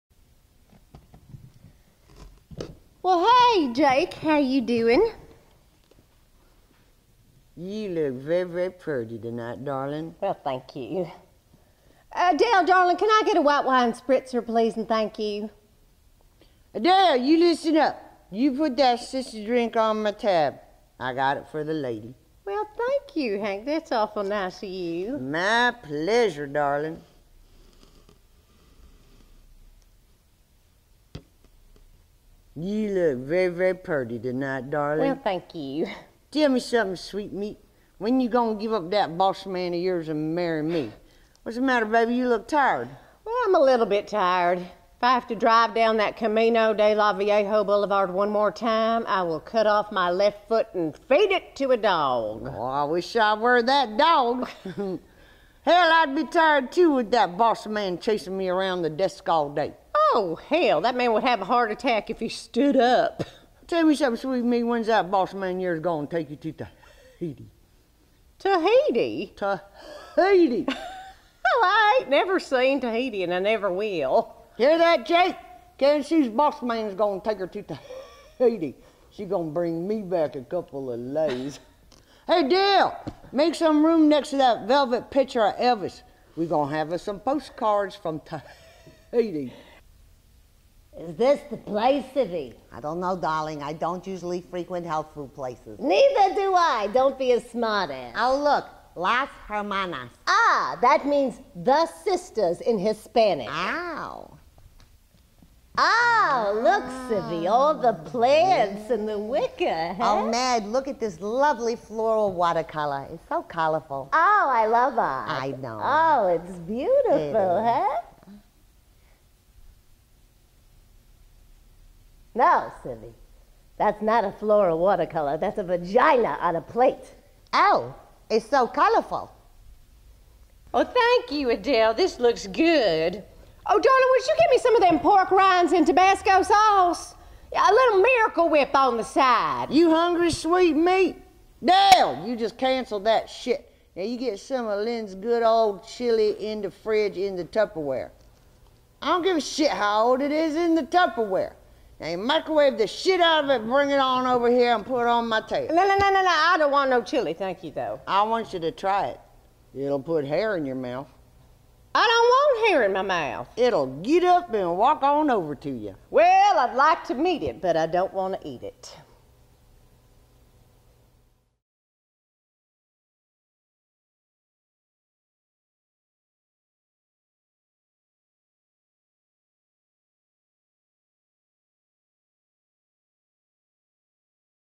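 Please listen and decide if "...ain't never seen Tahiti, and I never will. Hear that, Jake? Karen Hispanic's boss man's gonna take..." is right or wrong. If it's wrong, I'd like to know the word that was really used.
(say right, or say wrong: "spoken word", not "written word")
wrong: "Sue", not "Hispanic".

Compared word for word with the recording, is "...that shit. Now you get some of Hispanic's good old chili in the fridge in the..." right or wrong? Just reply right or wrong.
wrong.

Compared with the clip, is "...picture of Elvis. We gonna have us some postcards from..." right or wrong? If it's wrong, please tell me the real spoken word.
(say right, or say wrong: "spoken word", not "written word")
right.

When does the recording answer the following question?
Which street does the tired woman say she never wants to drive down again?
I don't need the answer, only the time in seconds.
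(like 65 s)
46 s.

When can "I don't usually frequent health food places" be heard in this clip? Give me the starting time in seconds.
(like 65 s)
93 s.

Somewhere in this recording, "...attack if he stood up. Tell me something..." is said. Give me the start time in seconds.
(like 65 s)
61 s.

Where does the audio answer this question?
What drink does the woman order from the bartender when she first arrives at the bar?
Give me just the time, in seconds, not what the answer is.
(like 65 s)
13 s.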